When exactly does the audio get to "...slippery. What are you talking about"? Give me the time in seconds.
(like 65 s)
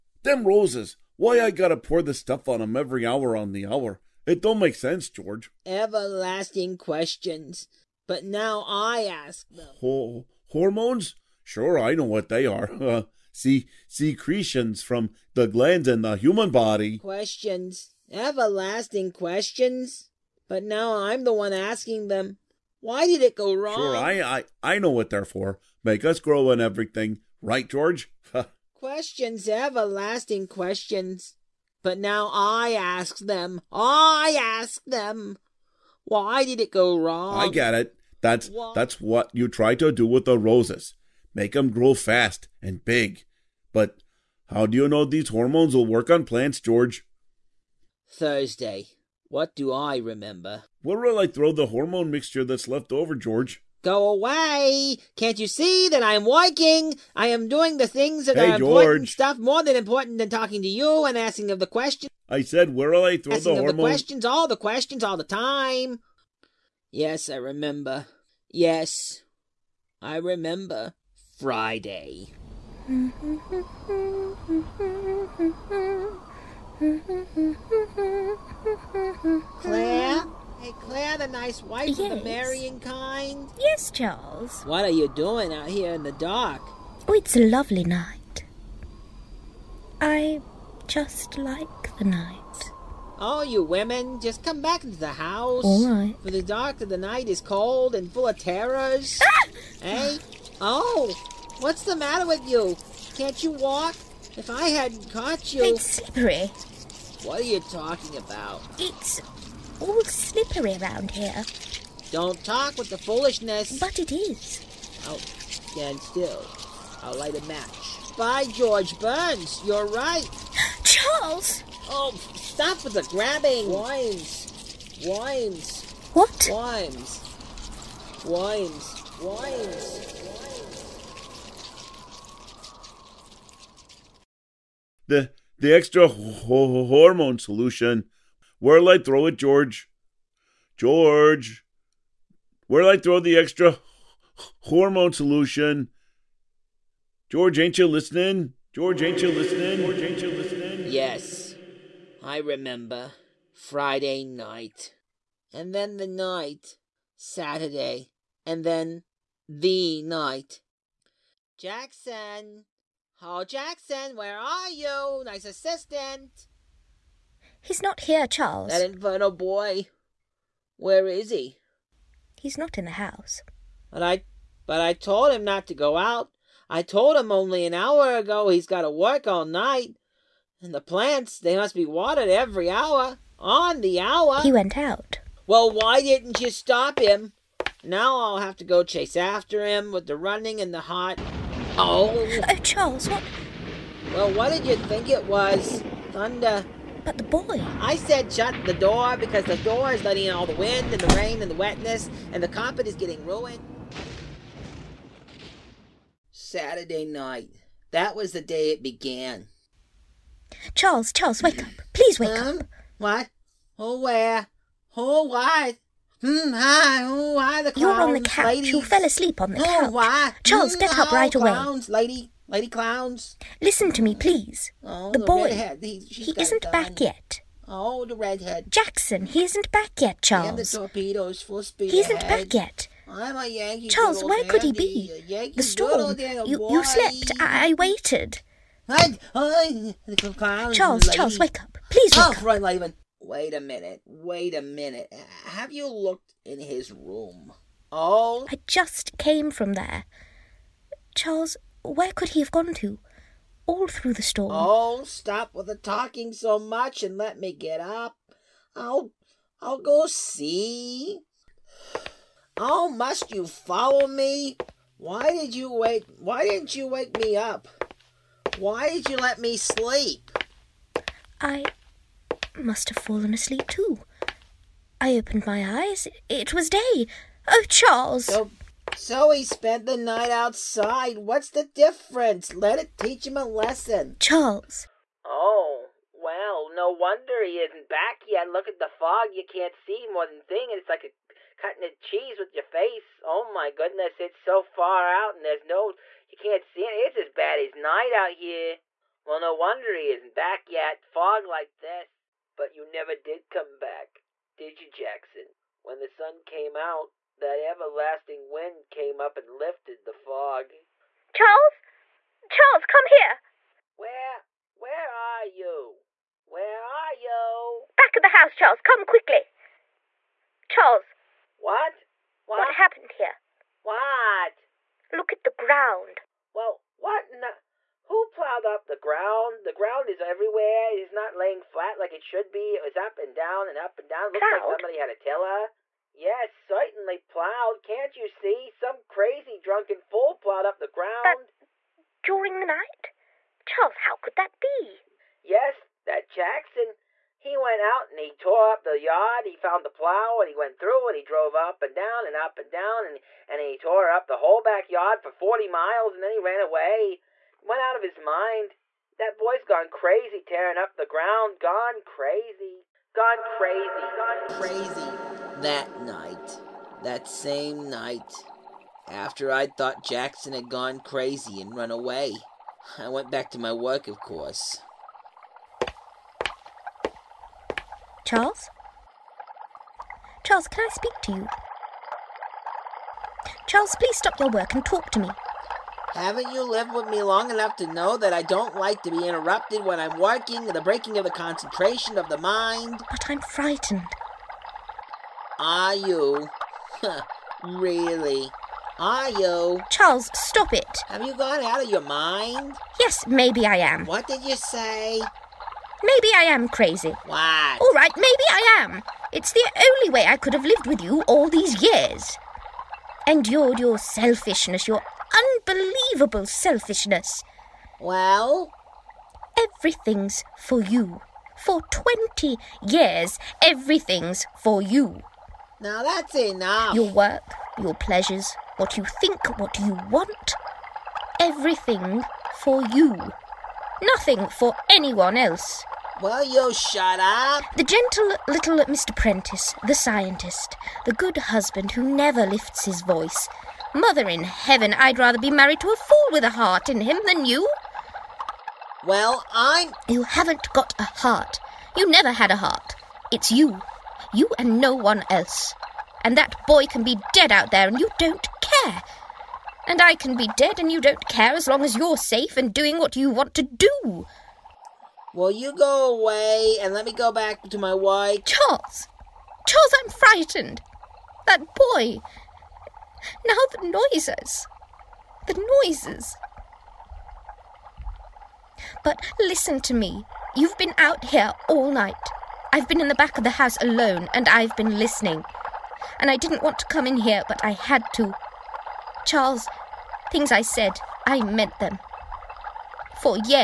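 105 s.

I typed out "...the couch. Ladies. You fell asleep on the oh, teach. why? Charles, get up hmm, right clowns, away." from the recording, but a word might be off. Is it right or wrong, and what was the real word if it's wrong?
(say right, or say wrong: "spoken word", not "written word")
wrong: "couch", not "teach".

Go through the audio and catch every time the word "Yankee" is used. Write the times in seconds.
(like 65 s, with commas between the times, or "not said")
233 s.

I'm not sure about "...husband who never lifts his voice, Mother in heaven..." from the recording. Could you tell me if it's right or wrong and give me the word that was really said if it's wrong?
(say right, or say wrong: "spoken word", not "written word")
right.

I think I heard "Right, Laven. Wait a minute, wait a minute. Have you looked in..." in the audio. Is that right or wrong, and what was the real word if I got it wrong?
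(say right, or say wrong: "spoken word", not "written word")
right.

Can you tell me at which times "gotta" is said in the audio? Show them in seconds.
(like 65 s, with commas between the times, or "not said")
1 s, 178 s.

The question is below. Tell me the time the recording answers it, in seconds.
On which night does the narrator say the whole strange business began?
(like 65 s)
206 s.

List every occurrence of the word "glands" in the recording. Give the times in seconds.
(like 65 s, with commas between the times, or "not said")
15 s.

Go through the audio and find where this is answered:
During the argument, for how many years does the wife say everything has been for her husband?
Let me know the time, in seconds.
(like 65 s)
421 s.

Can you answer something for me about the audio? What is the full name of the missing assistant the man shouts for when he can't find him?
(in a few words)
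Hall Jackson.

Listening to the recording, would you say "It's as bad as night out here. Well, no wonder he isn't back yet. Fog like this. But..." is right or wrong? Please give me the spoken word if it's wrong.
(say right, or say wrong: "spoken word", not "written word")
right.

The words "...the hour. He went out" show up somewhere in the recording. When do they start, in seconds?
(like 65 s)
183 s.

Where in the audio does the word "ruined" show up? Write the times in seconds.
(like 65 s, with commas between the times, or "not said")
203 s.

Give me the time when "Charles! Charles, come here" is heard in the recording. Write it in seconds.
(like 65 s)
311 s.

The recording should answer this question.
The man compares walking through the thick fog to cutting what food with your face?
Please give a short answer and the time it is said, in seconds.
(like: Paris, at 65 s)
Cheese, at 291 s.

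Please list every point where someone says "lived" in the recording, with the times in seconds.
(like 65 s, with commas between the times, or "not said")
386 s, 410 s.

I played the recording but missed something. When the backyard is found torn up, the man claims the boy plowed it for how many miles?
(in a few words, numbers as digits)
40 miles.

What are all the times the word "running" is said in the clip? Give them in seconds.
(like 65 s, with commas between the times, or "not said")
190 s.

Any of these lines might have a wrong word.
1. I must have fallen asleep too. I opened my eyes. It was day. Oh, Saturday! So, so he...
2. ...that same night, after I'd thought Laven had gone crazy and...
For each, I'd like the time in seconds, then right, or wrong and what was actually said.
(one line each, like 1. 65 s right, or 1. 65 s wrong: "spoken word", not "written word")
1. 271 s wrong: "Charles", not "Saturday"
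2. 367 s wrong: "Jackson", not "Laven".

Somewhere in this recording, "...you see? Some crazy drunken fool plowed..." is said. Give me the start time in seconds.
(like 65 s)
338 s.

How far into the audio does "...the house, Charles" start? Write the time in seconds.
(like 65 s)
318 s.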